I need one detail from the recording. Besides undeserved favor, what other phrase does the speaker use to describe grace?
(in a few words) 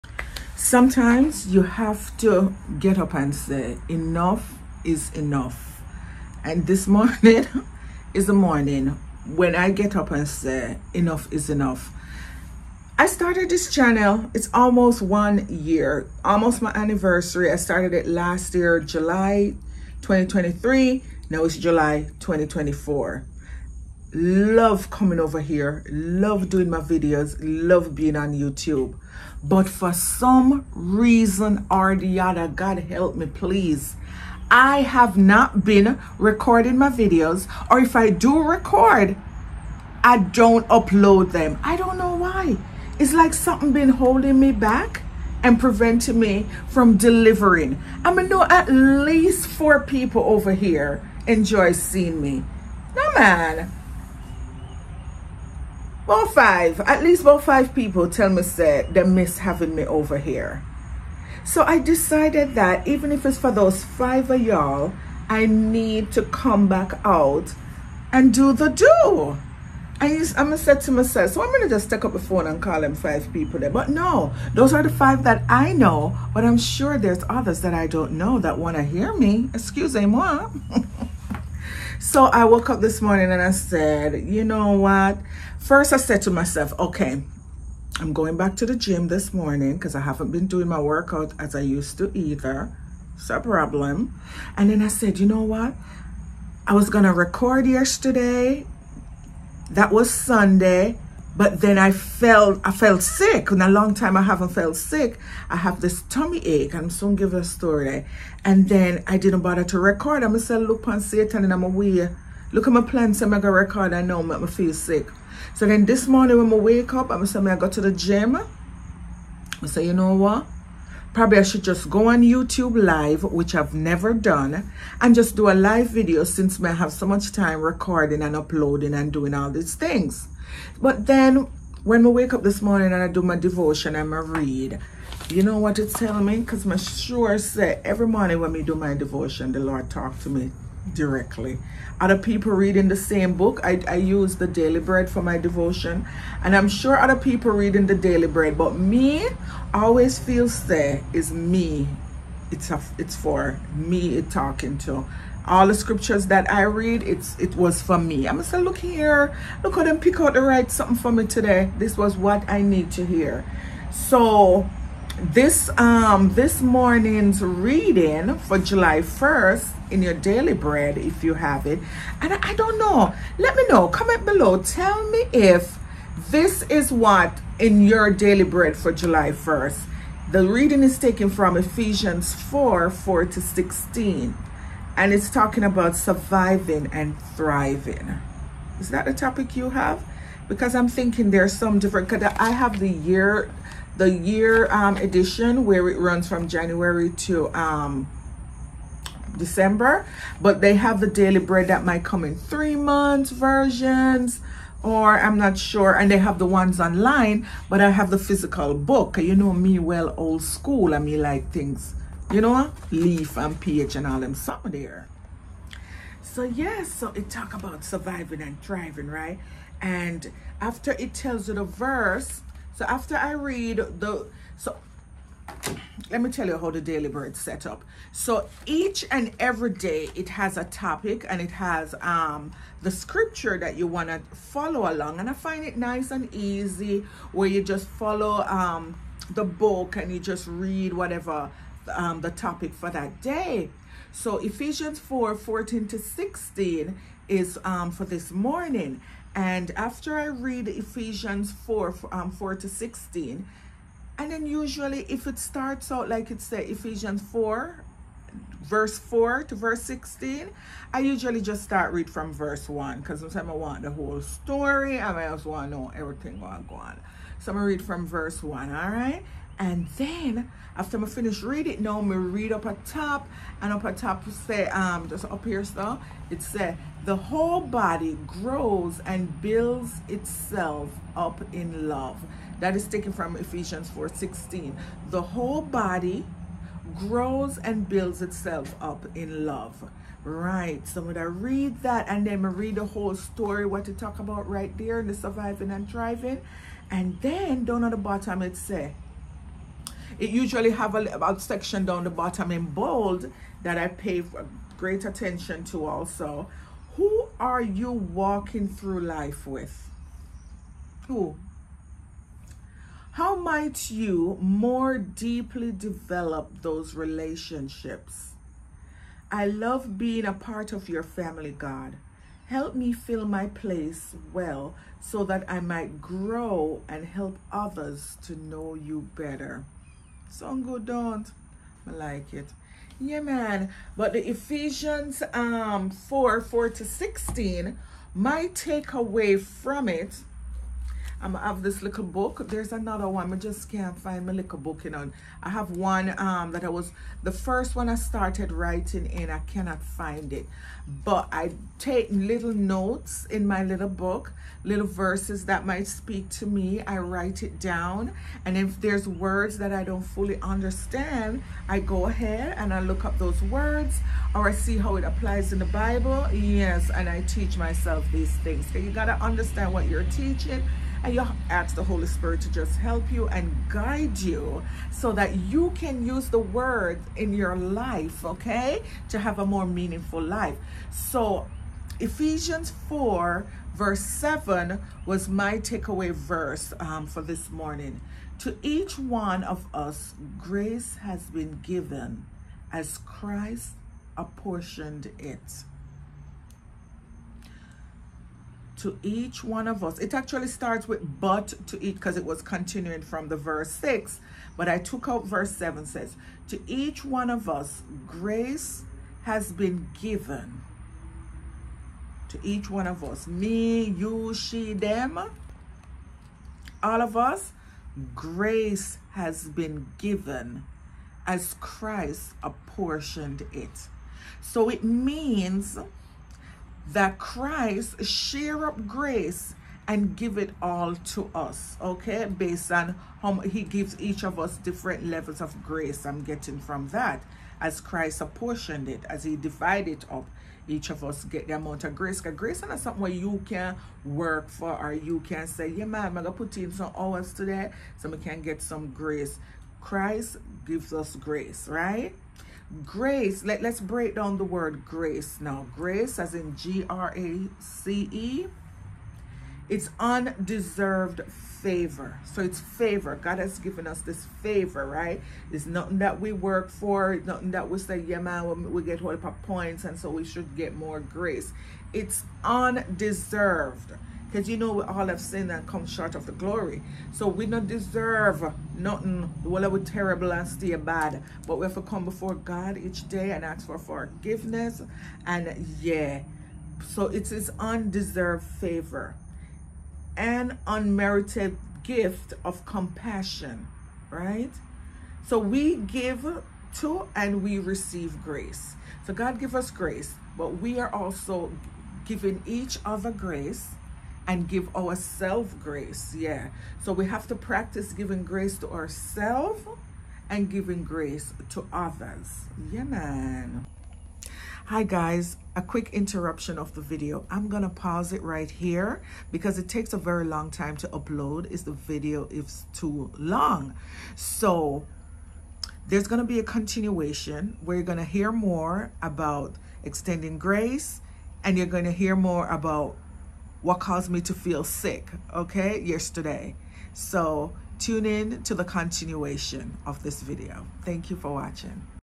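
Unmerited gift of compassion.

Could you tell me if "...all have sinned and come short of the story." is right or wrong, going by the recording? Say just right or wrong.
wrong.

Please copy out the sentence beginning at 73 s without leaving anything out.
But no, those are the five that I know, but I'm sure there's others that I don't know that wanna hear me.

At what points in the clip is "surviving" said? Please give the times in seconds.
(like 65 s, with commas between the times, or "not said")
185 s, 217 s, 295 s.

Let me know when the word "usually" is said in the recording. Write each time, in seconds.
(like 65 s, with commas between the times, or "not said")
254 s, 260 s, 300 s.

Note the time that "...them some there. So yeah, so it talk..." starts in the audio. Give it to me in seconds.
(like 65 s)
214 s.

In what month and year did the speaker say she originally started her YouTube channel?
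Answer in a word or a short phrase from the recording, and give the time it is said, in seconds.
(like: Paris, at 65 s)
July 2023, at 18 s.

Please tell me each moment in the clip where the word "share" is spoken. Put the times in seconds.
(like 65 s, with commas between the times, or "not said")
428 s.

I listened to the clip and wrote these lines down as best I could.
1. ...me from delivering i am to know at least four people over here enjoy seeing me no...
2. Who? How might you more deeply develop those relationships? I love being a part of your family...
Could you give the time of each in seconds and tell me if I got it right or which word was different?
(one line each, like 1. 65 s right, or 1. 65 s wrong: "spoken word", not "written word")
1. 46 s right
2. 311 s right.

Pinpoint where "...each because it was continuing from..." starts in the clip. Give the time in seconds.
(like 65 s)
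401 s.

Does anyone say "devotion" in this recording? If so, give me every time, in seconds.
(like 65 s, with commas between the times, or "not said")
133 s, 138 s, 145 s.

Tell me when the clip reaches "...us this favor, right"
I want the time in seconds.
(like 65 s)
463 s.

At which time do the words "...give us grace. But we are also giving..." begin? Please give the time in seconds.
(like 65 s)
499 s.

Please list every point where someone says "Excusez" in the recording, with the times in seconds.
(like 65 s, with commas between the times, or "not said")
79 s.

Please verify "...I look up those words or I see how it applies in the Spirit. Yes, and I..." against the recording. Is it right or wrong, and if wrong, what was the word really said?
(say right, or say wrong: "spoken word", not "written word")
wrong: "Bible", not "Spirit".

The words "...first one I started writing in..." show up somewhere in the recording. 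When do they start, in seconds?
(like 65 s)
347 s.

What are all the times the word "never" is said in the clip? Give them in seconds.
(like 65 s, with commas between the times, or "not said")
123 s.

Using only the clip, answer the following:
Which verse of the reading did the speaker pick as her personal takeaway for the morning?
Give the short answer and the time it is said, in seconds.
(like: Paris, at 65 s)
Ephesians 4:7, at 381 s.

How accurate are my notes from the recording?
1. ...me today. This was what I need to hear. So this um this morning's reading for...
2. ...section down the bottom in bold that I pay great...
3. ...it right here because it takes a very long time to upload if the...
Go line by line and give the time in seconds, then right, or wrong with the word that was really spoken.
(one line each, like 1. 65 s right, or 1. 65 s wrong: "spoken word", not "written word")
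1. 161 s right
2. 301 s right
3. 518 s right.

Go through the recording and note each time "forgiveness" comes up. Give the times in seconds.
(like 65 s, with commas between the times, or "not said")
483 s.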